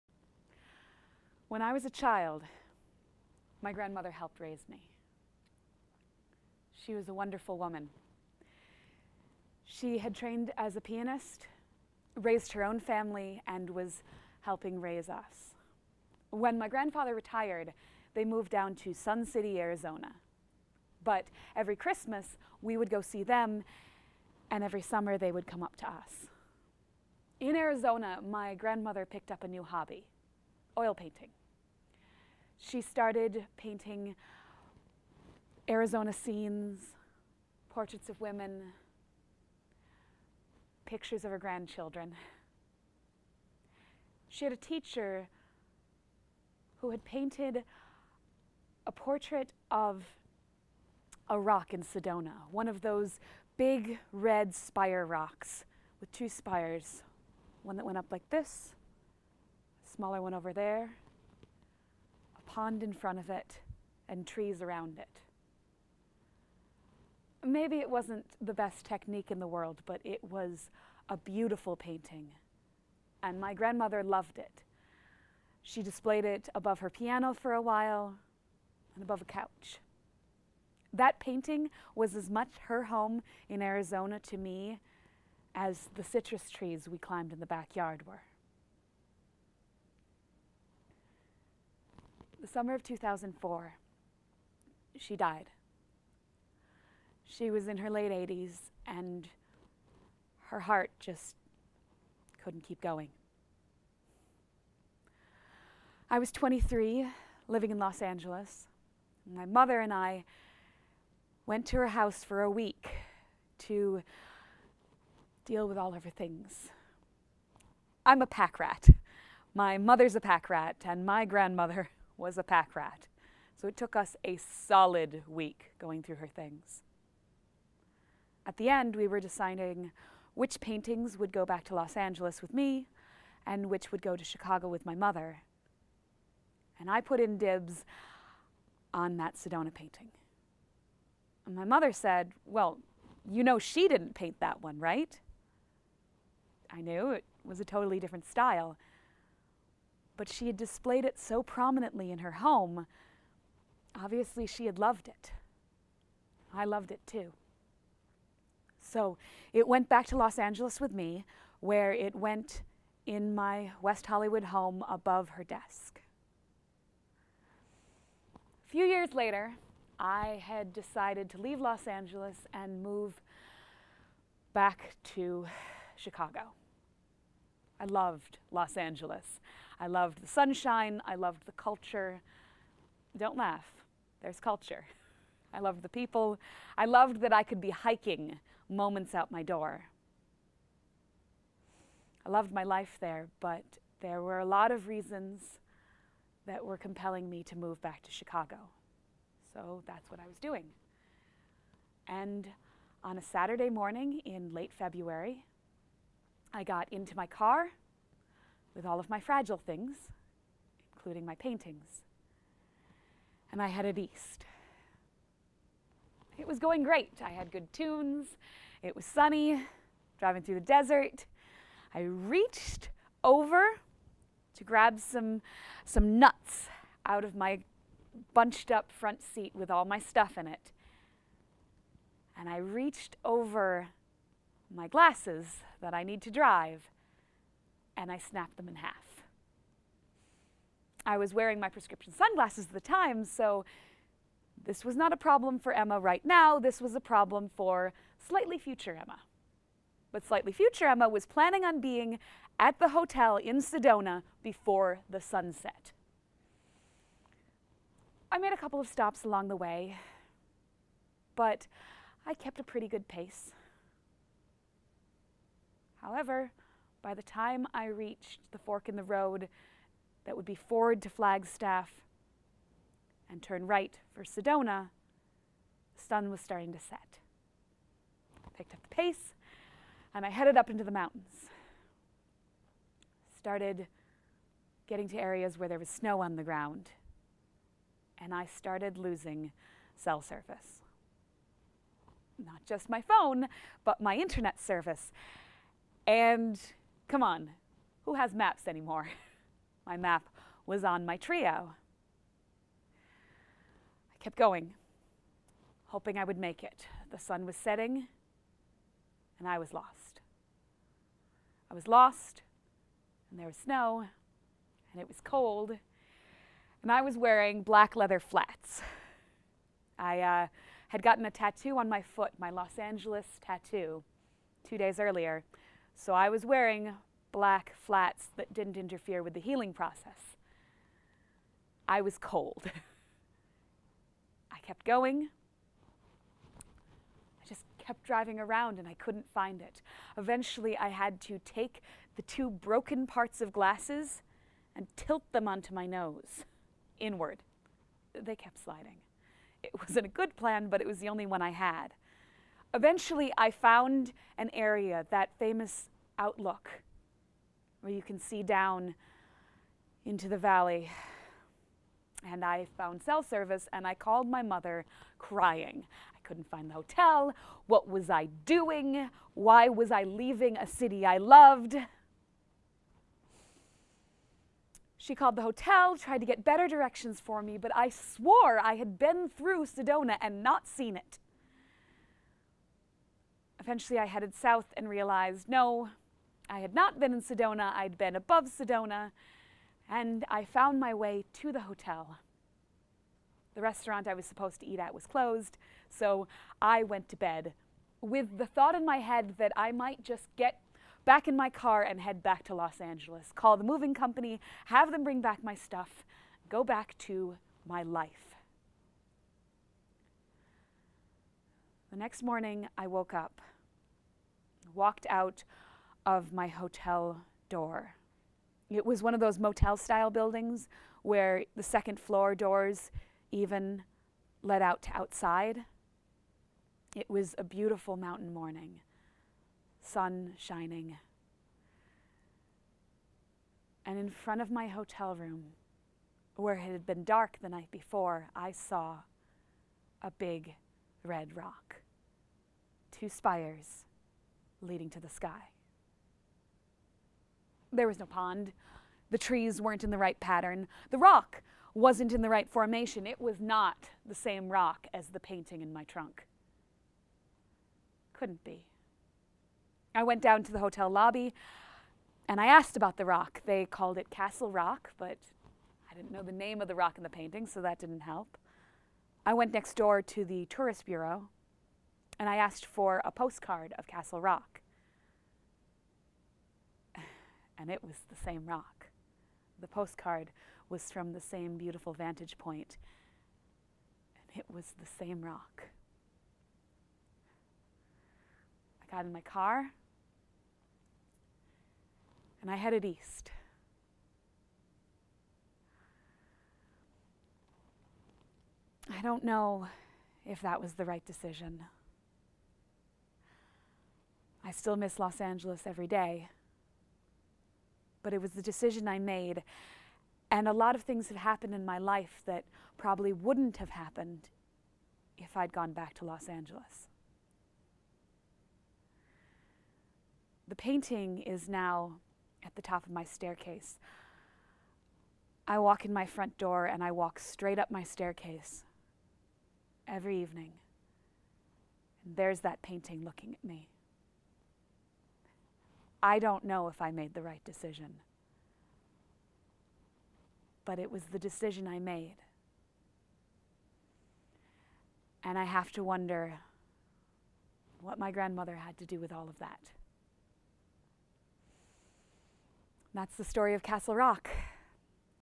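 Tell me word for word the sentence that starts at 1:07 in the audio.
Maybe it wasn't the best technique in the world, but it was a beautiful painting.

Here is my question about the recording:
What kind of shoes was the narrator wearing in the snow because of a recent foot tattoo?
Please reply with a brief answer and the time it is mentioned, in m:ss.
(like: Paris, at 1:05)
Black leather flats, at 5:17.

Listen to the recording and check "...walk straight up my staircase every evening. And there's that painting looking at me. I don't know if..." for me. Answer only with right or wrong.
right.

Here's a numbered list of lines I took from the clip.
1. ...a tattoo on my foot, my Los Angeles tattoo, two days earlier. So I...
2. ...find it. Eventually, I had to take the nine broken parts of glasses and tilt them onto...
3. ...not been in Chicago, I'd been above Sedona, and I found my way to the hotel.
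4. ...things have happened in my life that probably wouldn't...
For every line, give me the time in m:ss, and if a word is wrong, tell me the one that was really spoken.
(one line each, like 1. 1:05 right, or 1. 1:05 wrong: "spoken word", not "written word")
1. 5:21 right
2. 5:39 wrong: "two", not "nine"
3. 6:26 wrong: "Sedona", not "Chicago"
4. 8:30 right.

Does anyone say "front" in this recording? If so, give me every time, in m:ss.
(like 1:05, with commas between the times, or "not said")
1:02, 3:48, 7:14, 8:46.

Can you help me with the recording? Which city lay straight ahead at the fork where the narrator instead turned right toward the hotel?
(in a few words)
Flagstaff.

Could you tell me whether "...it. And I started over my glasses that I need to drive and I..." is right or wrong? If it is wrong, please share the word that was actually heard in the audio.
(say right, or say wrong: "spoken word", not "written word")
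wrong: "reached", not "started".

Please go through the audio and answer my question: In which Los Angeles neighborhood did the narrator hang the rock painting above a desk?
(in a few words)
West Hollywood.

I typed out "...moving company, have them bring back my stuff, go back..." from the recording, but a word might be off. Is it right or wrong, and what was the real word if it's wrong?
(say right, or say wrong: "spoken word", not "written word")
right.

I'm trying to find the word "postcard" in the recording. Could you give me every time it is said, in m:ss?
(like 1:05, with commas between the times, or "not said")
7:53, 7:59.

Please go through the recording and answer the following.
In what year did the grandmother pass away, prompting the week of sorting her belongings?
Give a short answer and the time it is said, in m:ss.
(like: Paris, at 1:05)
2004, at 1:32.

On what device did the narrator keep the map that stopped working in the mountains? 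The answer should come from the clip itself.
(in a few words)
Treo.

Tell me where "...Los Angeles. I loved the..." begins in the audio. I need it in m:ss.
2:58.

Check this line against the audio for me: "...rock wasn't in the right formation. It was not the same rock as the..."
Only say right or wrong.
right.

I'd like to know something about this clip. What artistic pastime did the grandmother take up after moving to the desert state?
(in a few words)
Oil painting.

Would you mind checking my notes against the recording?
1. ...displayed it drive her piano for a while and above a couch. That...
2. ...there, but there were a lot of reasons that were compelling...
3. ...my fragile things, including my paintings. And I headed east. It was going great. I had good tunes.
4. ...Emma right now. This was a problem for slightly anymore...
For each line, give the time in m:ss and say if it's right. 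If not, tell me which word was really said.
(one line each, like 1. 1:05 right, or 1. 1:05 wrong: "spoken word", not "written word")
1. 1:15 wrong: "above", not "drive"
2. 3:13 right
3. 3:29 right
4. 4:05 wrong: "future", not "anymore".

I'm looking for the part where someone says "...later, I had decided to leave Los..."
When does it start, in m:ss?
2:49.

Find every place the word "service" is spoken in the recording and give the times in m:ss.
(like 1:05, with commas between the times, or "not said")
4:50, 4:54, 6:03.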